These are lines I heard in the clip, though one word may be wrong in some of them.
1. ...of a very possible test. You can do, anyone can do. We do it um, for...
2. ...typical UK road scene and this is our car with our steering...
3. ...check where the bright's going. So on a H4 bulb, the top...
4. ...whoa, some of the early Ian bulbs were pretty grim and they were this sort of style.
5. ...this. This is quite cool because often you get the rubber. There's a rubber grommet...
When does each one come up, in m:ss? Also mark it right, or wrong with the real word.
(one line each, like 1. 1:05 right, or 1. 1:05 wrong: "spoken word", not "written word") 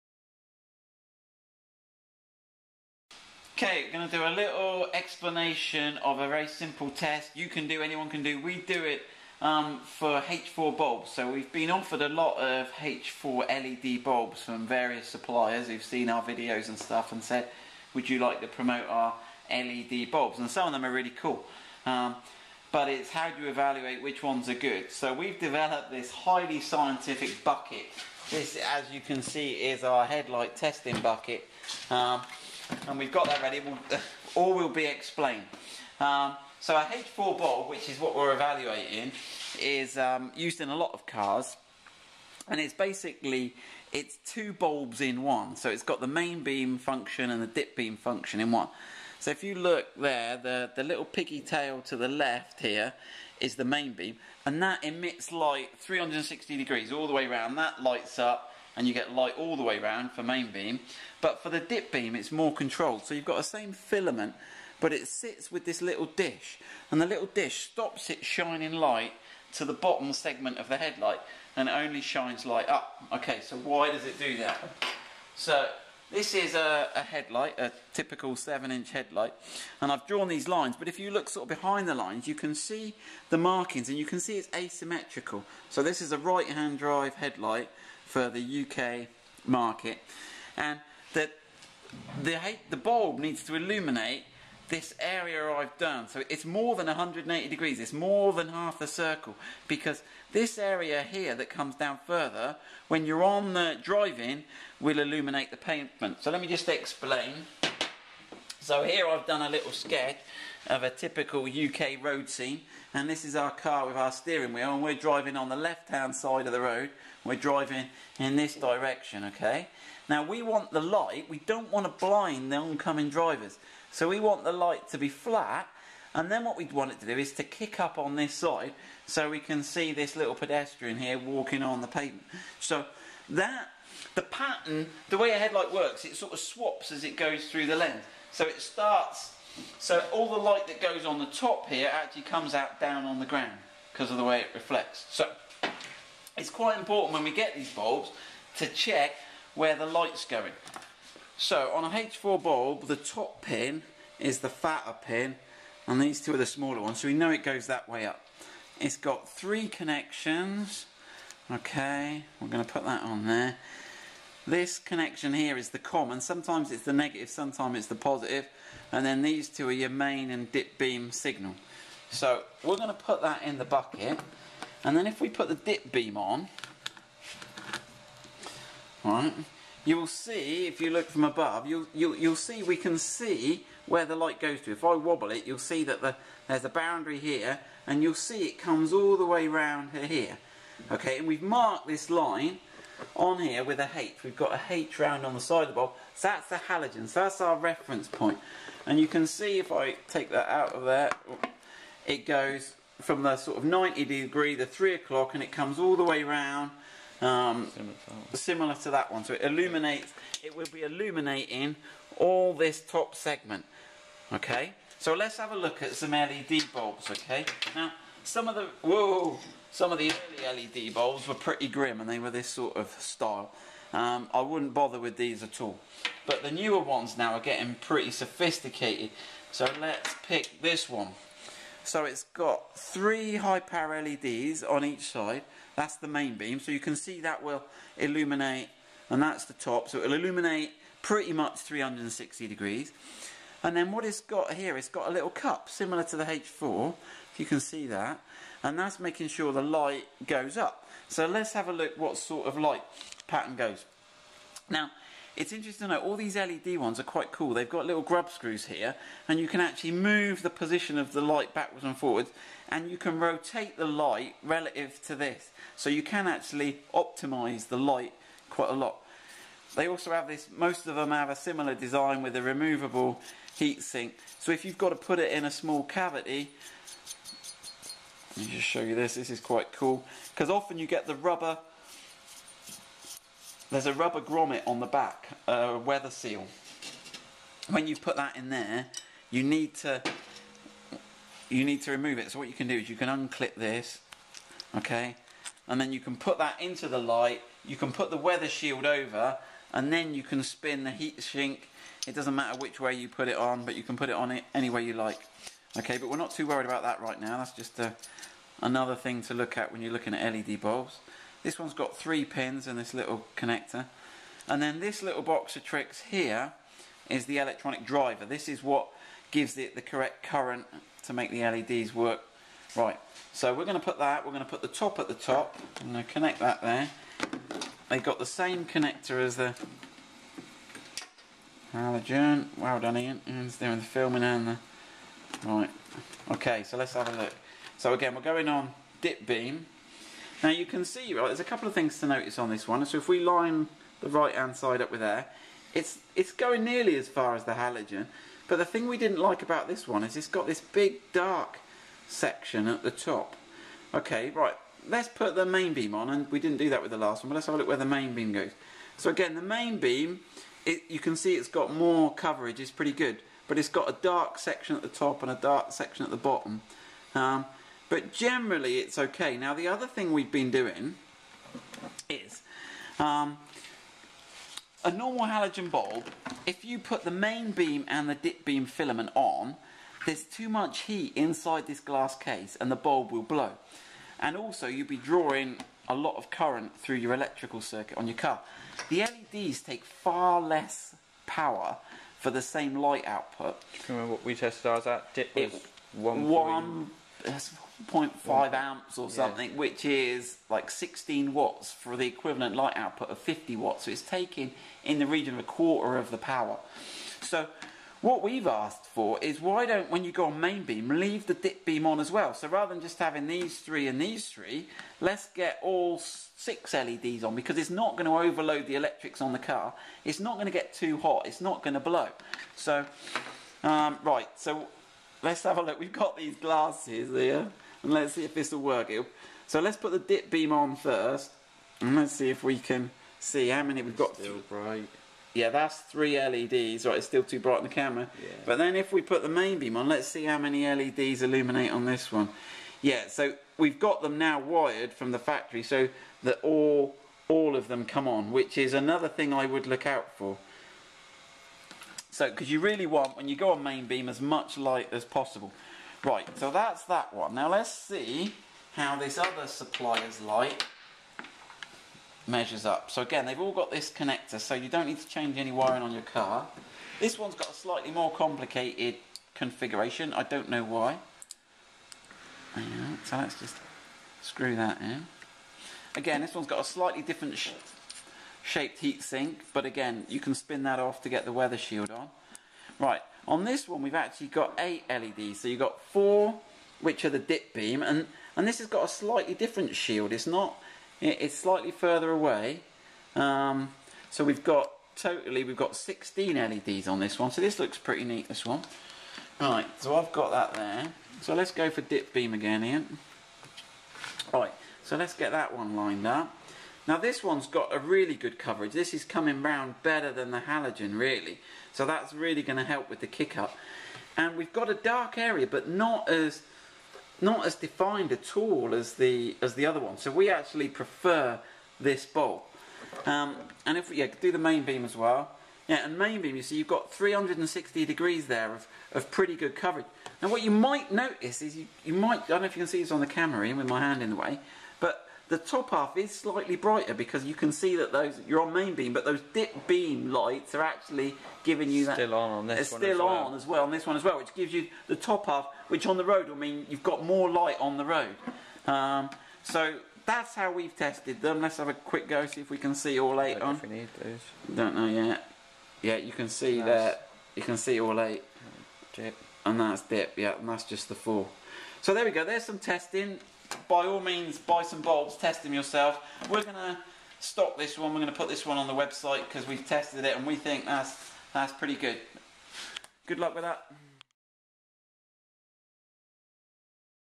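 1. 0:05 wrong: "simple", not "possible"
2. 1:50 right
3. 2:28 wrong: "light", not "bright"
4. 3:38 wrong: "LED", not "Ian"
5. 4:38 right.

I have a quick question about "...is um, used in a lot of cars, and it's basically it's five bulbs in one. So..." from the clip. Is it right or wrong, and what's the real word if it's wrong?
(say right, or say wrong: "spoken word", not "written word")
wrong: "two", not "five".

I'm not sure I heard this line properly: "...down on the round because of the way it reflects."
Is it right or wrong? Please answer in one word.
wrong.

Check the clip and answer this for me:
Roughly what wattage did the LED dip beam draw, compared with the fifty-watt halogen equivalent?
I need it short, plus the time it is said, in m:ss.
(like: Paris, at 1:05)
16 watts, at 6:40.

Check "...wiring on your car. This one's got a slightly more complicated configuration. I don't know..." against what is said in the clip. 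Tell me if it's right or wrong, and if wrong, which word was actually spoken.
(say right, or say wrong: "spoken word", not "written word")
right.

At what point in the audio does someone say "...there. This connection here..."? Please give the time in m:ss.
2:43.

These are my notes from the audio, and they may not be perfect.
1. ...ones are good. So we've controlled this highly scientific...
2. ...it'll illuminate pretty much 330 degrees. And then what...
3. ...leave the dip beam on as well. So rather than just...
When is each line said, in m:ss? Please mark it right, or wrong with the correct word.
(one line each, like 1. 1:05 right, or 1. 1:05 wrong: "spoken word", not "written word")
1. 0:24 wrong: "developed", not "controlled"
2. 3:59 wrong: "360", not "330"
3. 6:50 right.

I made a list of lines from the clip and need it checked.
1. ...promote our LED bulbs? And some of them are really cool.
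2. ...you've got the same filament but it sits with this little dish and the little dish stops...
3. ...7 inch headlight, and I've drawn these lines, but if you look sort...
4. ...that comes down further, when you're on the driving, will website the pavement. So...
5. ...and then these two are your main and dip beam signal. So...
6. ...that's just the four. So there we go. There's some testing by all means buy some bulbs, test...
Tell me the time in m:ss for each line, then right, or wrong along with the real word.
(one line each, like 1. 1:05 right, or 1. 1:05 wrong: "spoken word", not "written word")
1. 0:18 right
2. 1:03 right
3. 1:18 right
4. 1:41 wrong: "illuminate", not "website"
5. 2:48 right
6. 9:20 right.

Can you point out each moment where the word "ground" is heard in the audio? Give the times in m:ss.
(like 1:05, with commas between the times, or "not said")
2:23.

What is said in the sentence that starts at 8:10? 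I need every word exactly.
It's not it's slightly further away.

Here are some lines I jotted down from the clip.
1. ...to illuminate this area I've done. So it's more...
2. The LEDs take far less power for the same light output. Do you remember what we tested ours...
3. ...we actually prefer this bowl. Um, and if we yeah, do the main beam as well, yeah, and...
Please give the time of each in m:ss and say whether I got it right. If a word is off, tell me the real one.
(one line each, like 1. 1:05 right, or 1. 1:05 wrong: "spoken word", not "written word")
1. 1:33 right
2. 6:28 right
3. 8:40 right.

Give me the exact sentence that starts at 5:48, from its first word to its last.
But the thing we didn't like about this one is it's got this big dark section at the top.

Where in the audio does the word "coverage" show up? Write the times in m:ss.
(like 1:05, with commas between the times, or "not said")
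6:02, 8:28, 8:49.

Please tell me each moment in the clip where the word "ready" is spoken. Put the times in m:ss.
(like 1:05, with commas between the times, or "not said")
0:33.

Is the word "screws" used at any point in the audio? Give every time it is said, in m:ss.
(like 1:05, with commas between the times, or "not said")
4:18, 7:54.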